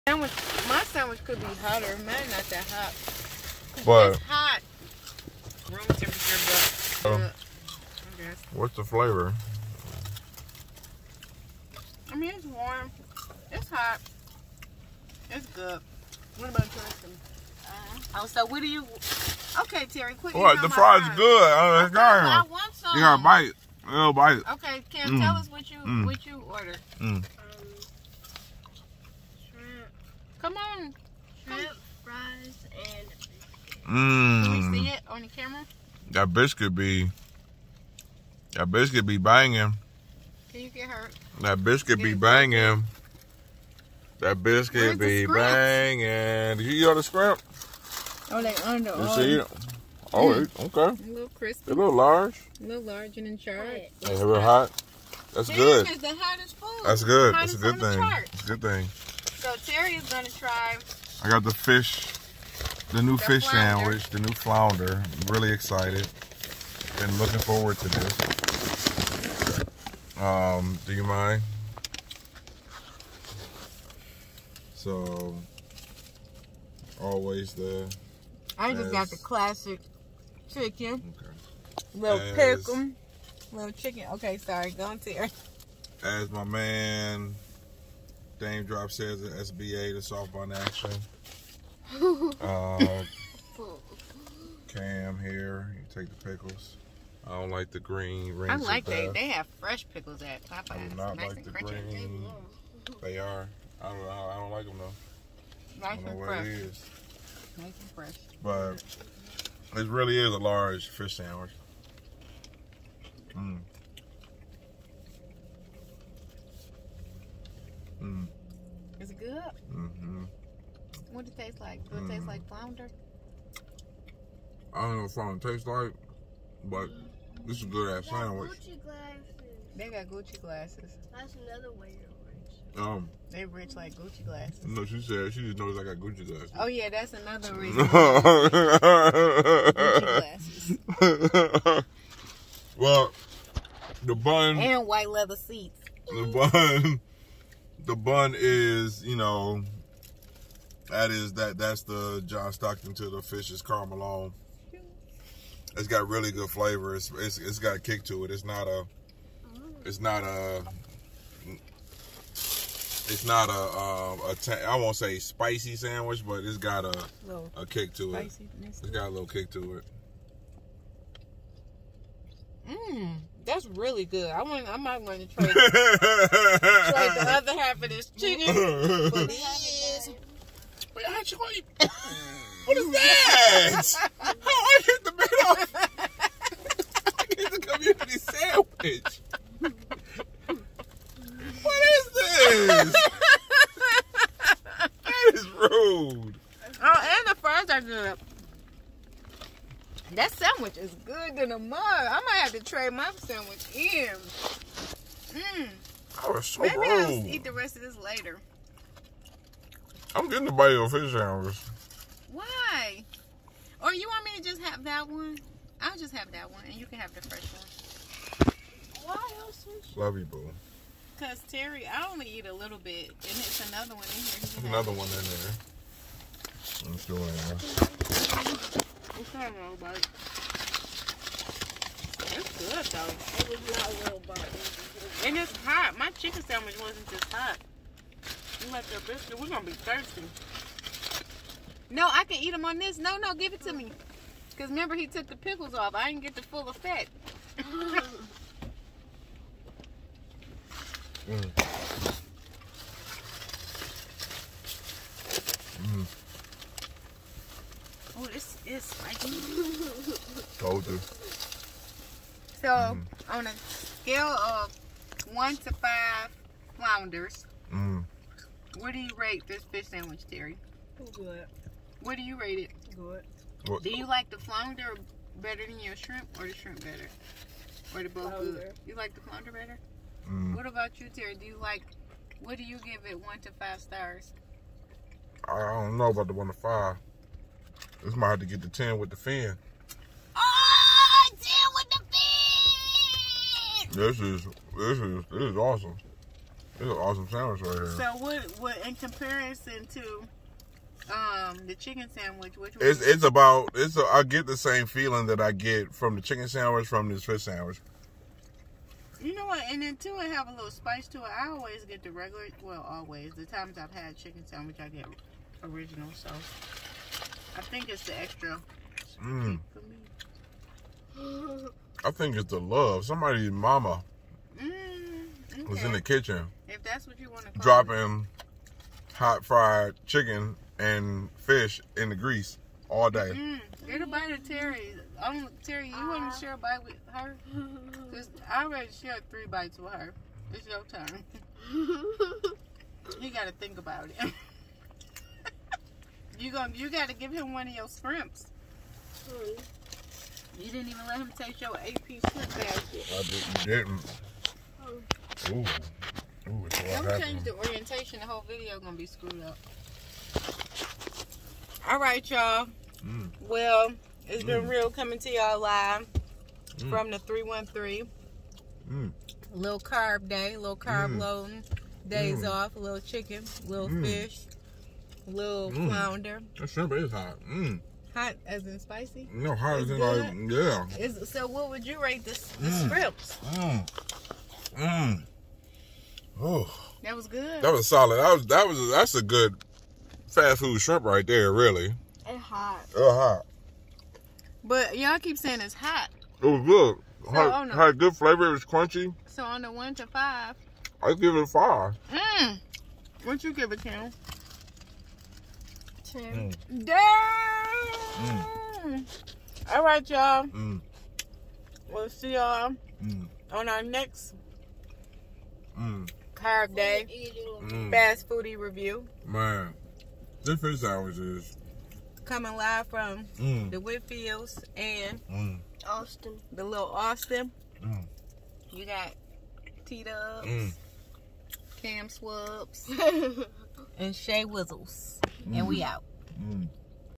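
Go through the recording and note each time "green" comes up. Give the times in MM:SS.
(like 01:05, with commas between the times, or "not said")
01:37, 01:41.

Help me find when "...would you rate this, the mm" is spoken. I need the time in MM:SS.
06:21.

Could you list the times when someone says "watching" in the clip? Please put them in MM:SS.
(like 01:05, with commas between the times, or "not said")
06:46.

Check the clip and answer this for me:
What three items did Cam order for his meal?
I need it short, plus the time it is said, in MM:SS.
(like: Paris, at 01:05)
Shrimp, fries, and biscuit, at 00:31.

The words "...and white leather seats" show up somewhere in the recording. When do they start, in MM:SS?
02:24.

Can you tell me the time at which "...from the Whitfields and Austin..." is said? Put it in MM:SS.
07:02.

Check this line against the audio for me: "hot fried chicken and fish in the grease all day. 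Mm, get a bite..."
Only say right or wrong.
right.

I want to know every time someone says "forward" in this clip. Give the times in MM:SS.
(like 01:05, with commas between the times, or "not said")
01:07.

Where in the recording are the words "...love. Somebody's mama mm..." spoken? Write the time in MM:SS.
05:22.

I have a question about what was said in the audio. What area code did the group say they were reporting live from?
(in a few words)
313.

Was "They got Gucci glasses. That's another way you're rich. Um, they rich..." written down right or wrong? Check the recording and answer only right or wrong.
right.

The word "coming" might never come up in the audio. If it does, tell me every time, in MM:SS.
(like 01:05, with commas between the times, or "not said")
06:04, 07:02.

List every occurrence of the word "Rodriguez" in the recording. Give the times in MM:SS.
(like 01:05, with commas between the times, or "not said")
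not said.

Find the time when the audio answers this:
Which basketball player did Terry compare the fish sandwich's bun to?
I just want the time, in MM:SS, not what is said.
02:32.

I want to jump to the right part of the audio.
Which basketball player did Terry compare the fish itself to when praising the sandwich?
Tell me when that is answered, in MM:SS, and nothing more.
02:33.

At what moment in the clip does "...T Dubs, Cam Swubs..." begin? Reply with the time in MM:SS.
07:09.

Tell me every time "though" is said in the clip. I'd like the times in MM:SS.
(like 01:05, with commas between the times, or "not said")
01:44, 03:52.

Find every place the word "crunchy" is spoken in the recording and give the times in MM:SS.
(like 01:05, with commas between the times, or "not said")
01:41, 06:38.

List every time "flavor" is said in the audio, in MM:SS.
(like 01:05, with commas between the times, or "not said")
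00:08, 02:36, 06:38.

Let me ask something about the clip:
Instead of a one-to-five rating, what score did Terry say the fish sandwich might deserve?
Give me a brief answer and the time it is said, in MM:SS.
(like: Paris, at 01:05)
10 with the fin, at 04:48.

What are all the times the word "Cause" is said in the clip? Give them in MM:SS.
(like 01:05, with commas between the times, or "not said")
03:41, 04:04, 05:38.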